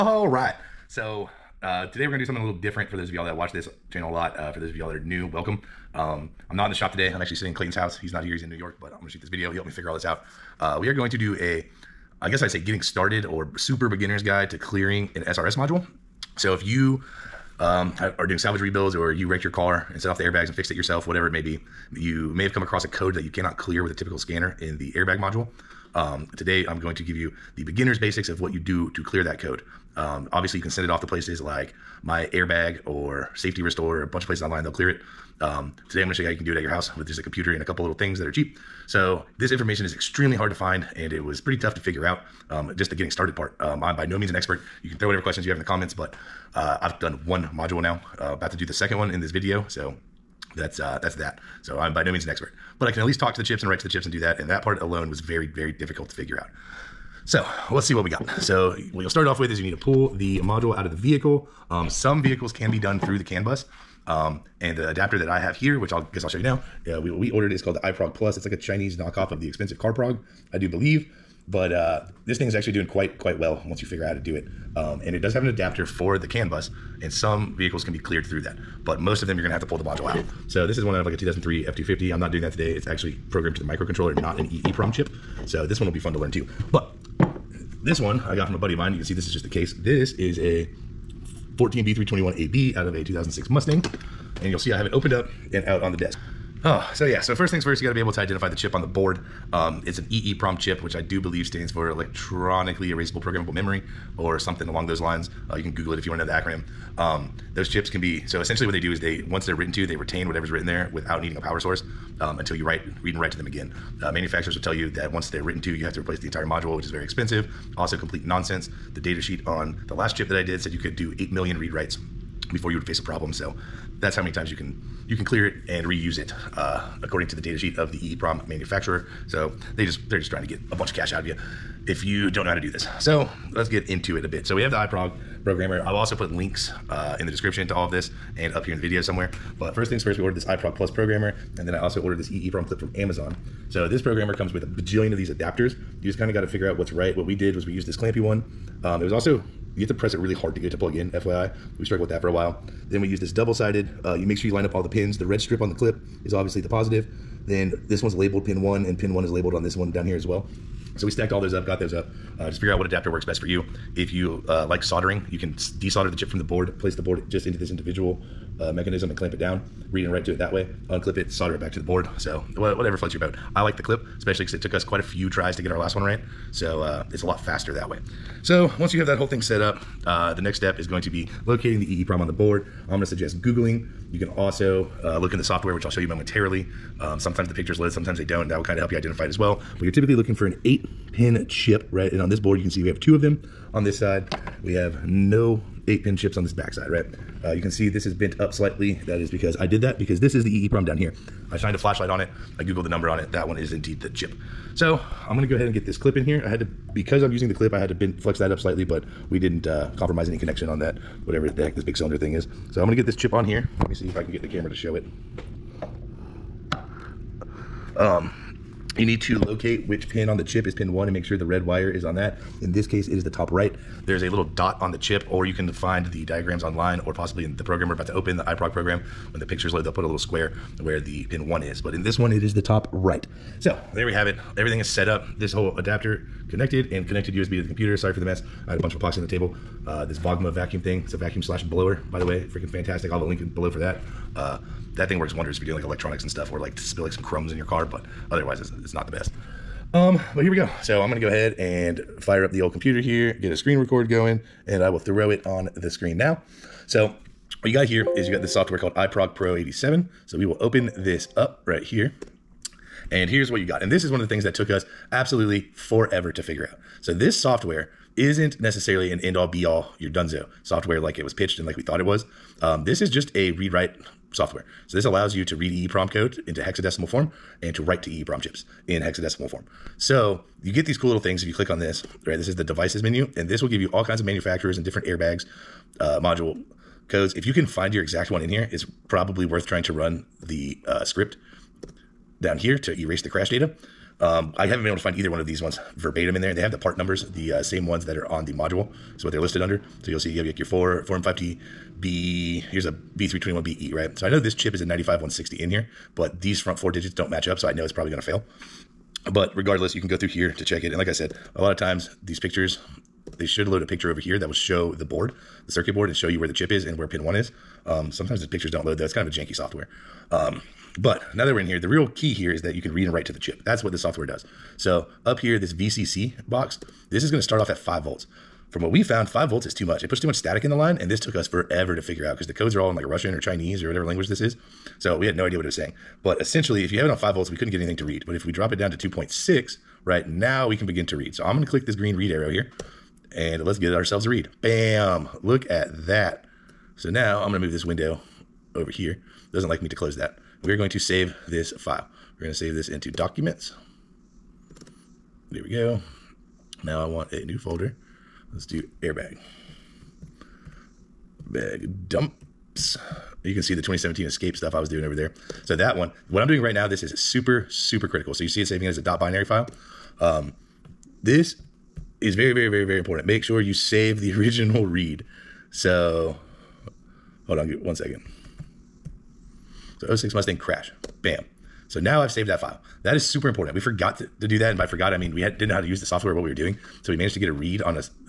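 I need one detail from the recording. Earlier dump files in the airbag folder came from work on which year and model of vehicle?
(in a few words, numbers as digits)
2017 Escape.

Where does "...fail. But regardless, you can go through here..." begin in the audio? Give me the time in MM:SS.
05:08.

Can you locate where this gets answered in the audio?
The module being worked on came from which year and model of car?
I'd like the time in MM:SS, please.
01:33.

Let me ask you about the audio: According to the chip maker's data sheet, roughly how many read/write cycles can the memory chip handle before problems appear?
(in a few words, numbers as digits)
8 million.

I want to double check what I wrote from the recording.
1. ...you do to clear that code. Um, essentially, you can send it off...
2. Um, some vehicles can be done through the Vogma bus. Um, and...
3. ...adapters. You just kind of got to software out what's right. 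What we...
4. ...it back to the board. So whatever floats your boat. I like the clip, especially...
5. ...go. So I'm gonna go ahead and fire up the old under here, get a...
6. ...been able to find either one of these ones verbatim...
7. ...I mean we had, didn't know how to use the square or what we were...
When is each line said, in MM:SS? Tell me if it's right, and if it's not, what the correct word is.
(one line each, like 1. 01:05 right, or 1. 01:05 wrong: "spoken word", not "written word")
1. 00:28 wrong: "obviously", not "essentially"
2. 01:01 wrong: "CAN", not "Vogma"
3. 02:25 wrong: "figure", not "software"
4. 02:51 right
5. 04:10 wrong: "computer", not "under"
6. 04:54 right
7. 06:25 wrong: "software", not "square".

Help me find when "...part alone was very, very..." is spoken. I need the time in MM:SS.
00:54.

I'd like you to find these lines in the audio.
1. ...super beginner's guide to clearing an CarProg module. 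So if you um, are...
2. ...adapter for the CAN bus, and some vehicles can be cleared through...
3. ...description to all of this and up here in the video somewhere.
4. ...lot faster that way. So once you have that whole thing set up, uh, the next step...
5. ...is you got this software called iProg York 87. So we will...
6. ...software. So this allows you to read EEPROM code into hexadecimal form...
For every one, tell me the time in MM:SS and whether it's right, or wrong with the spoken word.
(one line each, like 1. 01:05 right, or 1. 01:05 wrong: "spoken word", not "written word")
1. 00:13 wrong: "SRS", not "CarProg"
2. 01:15 right
3. 02:17 right
4. 02:57 right
5. 04:18 wrong: "Pro", not "York"
6. 04:34 right.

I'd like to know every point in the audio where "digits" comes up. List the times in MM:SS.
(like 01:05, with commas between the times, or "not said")
05:06.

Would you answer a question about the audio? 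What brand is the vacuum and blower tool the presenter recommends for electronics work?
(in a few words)
Vogma.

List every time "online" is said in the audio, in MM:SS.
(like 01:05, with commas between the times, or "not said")
00:34, 03:46.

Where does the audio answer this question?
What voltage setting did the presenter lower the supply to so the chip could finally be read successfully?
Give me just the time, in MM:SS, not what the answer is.
05:39.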